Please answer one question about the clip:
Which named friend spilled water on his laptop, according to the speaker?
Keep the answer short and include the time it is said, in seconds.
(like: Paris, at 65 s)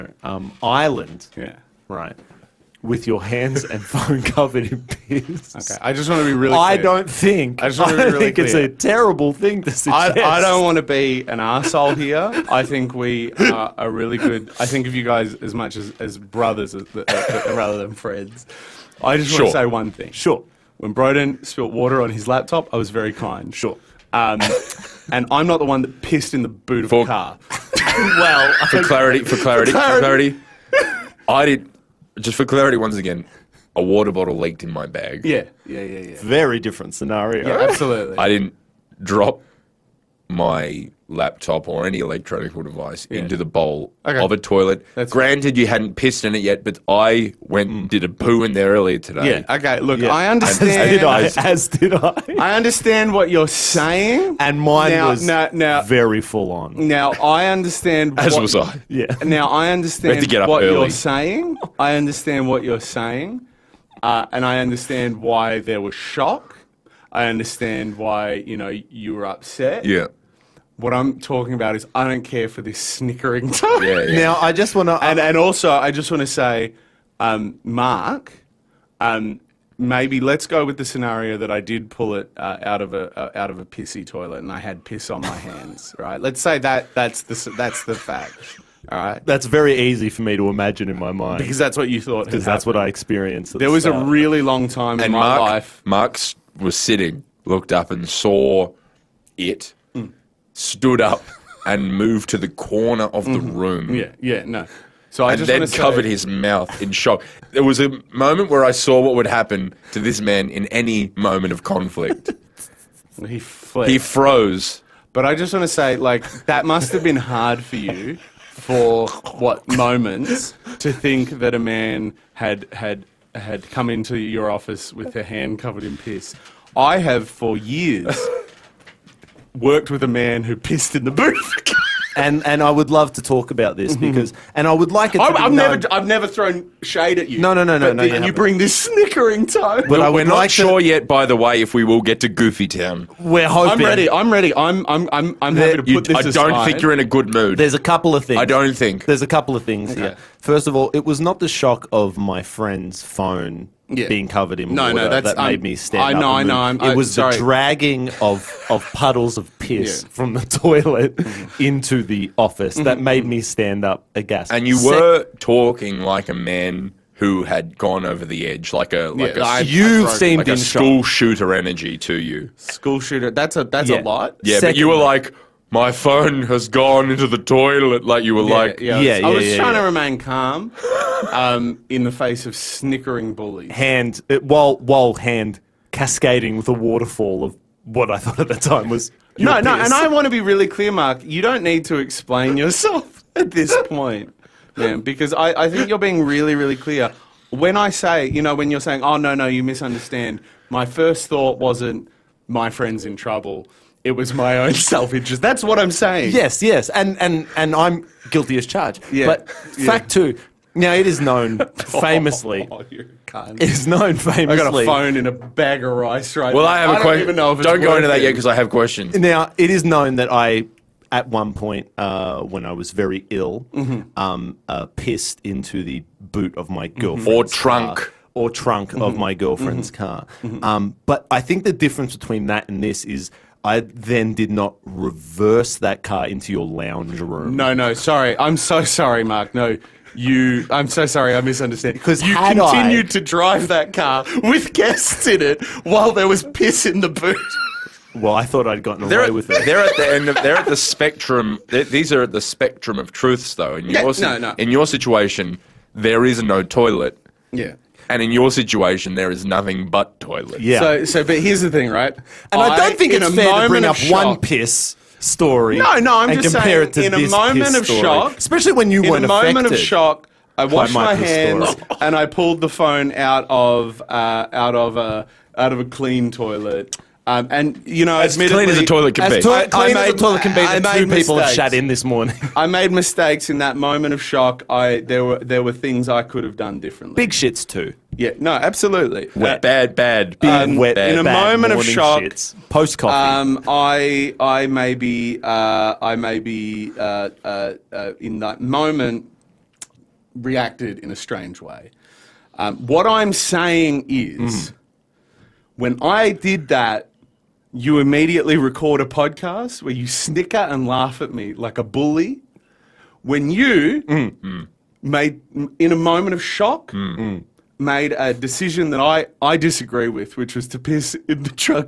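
Broden, at 20 s.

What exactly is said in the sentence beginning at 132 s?
and and I would love to talk about this mm-hmm.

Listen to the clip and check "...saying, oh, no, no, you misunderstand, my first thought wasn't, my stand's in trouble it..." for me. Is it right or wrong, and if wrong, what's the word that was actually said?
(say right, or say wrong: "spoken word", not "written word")
wrong: "friend", not "stand".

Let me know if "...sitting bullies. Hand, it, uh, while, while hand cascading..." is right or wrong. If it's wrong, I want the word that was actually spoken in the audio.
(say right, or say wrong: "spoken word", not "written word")
wrong: "snickering", not "sitting".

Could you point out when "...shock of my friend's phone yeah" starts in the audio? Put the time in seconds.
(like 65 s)
151 s.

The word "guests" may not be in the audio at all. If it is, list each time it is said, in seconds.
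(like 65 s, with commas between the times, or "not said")
244 s.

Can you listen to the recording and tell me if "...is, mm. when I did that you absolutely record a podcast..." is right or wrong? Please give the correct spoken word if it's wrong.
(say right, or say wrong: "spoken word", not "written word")
wrong: "immediately", not "absolutely".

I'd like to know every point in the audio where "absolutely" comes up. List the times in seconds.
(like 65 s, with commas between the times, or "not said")
37 s, 288 s.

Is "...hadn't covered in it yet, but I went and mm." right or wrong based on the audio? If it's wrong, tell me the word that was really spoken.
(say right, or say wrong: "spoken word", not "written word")
wrong: "pissed", not "covered".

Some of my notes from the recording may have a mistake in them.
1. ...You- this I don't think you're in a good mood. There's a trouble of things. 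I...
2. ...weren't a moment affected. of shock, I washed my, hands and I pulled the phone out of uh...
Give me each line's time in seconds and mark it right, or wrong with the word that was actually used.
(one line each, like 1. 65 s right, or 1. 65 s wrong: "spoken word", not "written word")
1. 145 s wrong: "couple", not "trouble"
2. 269 s right.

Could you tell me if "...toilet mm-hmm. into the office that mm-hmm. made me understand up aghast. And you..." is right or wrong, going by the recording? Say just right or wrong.
wrong.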